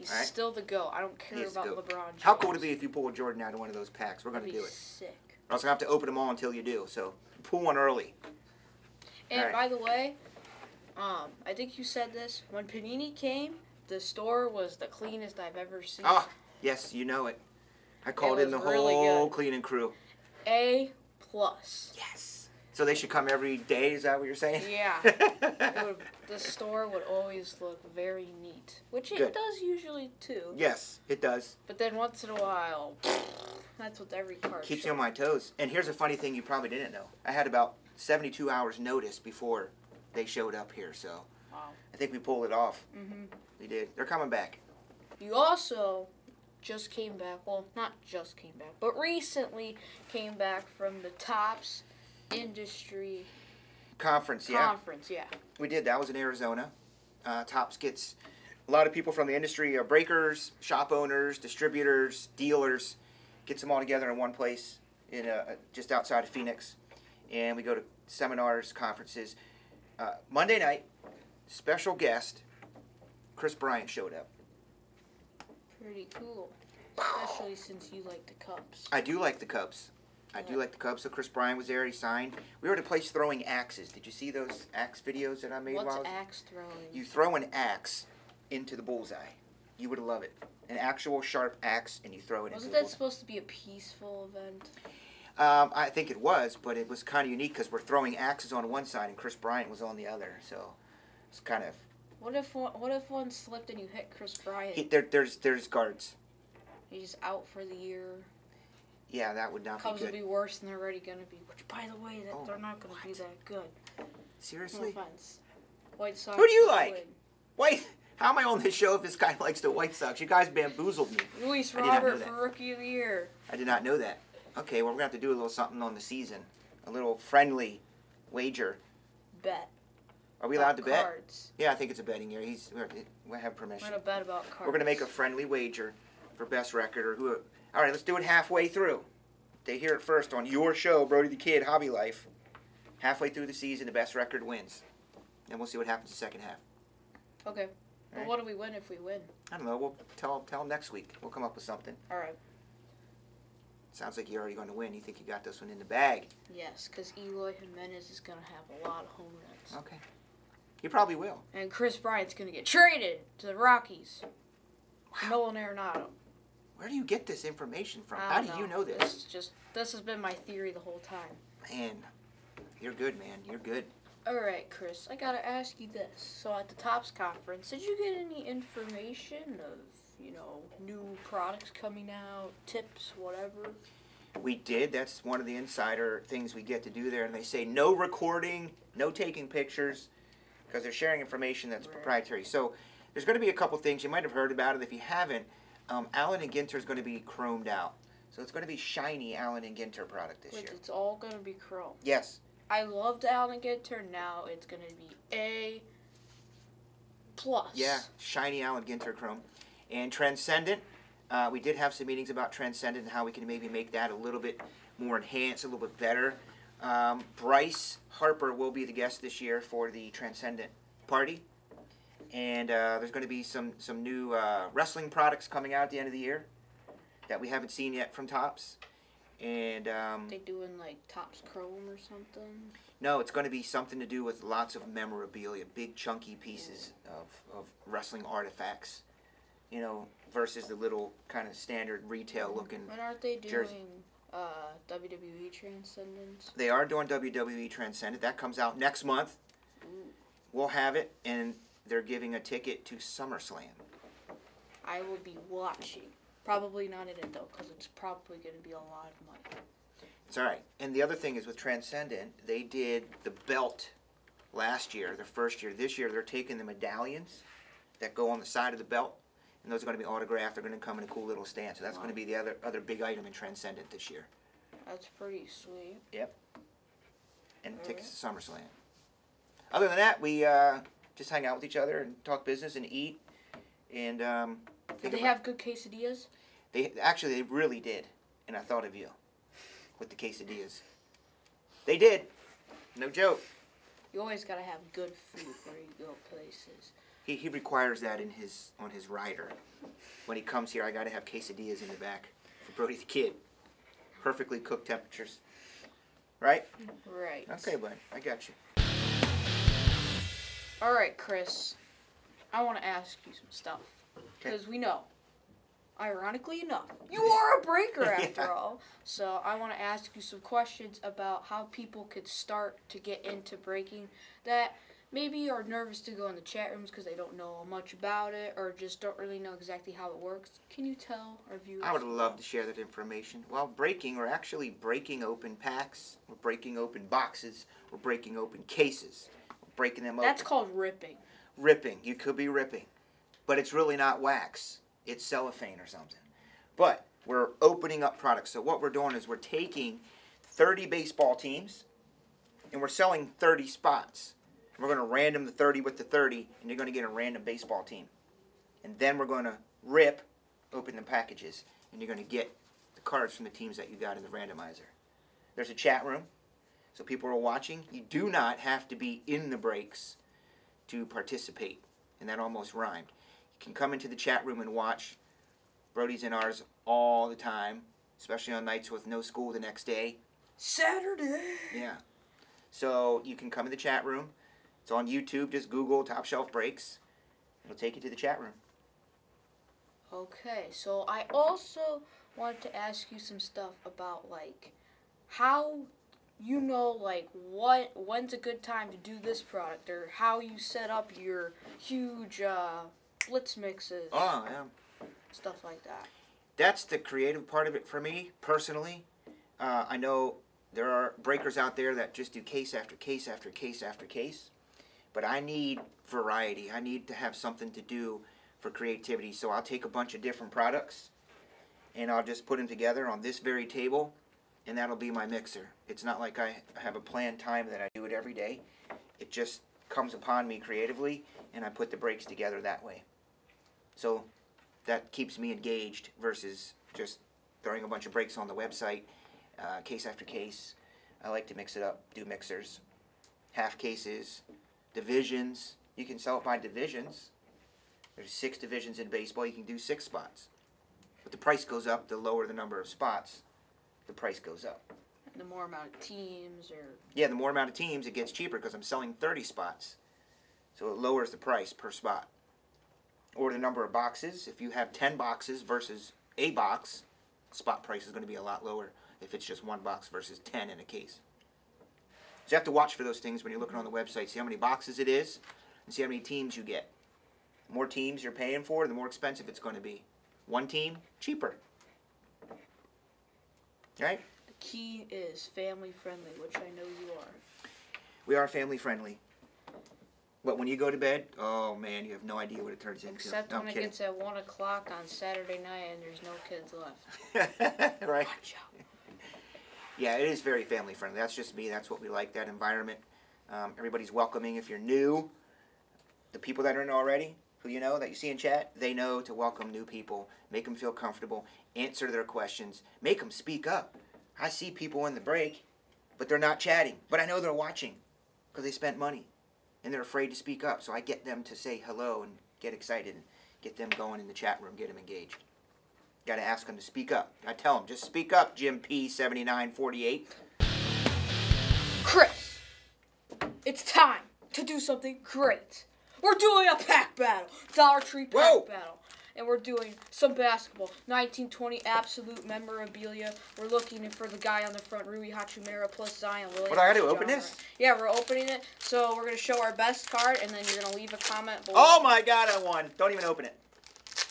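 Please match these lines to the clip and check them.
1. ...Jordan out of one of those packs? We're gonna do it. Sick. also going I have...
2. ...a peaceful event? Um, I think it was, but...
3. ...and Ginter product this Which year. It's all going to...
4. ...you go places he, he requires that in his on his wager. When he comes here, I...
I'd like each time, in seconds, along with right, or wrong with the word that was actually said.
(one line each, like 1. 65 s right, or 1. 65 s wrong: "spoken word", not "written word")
1. 3 s right
2. 93 s right
3. 199 s right
4. 295 s wrong: "rider", not "wager".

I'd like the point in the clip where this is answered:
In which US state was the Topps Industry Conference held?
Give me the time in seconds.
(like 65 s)
56 s.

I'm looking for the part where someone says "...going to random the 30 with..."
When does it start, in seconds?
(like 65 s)
354 s.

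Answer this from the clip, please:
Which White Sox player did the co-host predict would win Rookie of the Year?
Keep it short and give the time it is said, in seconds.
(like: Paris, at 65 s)
Luis Robert, at 121 s.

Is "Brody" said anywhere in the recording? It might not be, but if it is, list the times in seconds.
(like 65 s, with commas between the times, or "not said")
141 s, 302 s, 375 s.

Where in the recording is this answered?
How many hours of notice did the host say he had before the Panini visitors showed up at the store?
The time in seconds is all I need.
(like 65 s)
37 s.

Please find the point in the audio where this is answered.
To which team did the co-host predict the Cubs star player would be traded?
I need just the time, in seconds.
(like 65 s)
163 s.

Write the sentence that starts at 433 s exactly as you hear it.
So that keeps me engaged versus just throwing a bunch of breaks on the website, uh, case after case.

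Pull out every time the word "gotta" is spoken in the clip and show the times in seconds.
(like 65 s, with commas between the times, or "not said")
175 s, 294 s, 546 s.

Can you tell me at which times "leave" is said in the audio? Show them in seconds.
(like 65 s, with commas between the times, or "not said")
550 s.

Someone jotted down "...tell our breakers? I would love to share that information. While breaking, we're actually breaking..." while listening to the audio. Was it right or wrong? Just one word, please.
wrong.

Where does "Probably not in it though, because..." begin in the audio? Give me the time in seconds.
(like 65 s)
256 s.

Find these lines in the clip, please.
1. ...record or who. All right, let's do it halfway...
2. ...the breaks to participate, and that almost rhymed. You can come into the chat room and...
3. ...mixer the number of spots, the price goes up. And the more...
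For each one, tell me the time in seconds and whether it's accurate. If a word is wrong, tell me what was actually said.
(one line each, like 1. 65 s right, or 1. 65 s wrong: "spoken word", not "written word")
1. 136 s right
2. 369 s right
3. 452 s wrong: "lower", not "mixer".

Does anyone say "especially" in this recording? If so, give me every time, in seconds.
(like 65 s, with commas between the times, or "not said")
76 s, 378 s.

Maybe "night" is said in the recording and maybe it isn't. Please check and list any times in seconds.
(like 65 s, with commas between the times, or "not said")
70 s, 378 s, 495 s.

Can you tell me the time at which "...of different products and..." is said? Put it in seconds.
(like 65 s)
420 s.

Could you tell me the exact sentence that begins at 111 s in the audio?
Which, by the way, that oh, they're not going to be that good.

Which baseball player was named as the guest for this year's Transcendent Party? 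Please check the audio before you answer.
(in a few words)
Bryce Harper.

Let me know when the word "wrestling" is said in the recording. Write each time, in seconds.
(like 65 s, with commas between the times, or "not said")
224 s, 237 s.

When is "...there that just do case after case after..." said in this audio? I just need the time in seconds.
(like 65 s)
411 s.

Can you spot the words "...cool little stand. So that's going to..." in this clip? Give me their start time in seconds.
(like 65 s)
271 s.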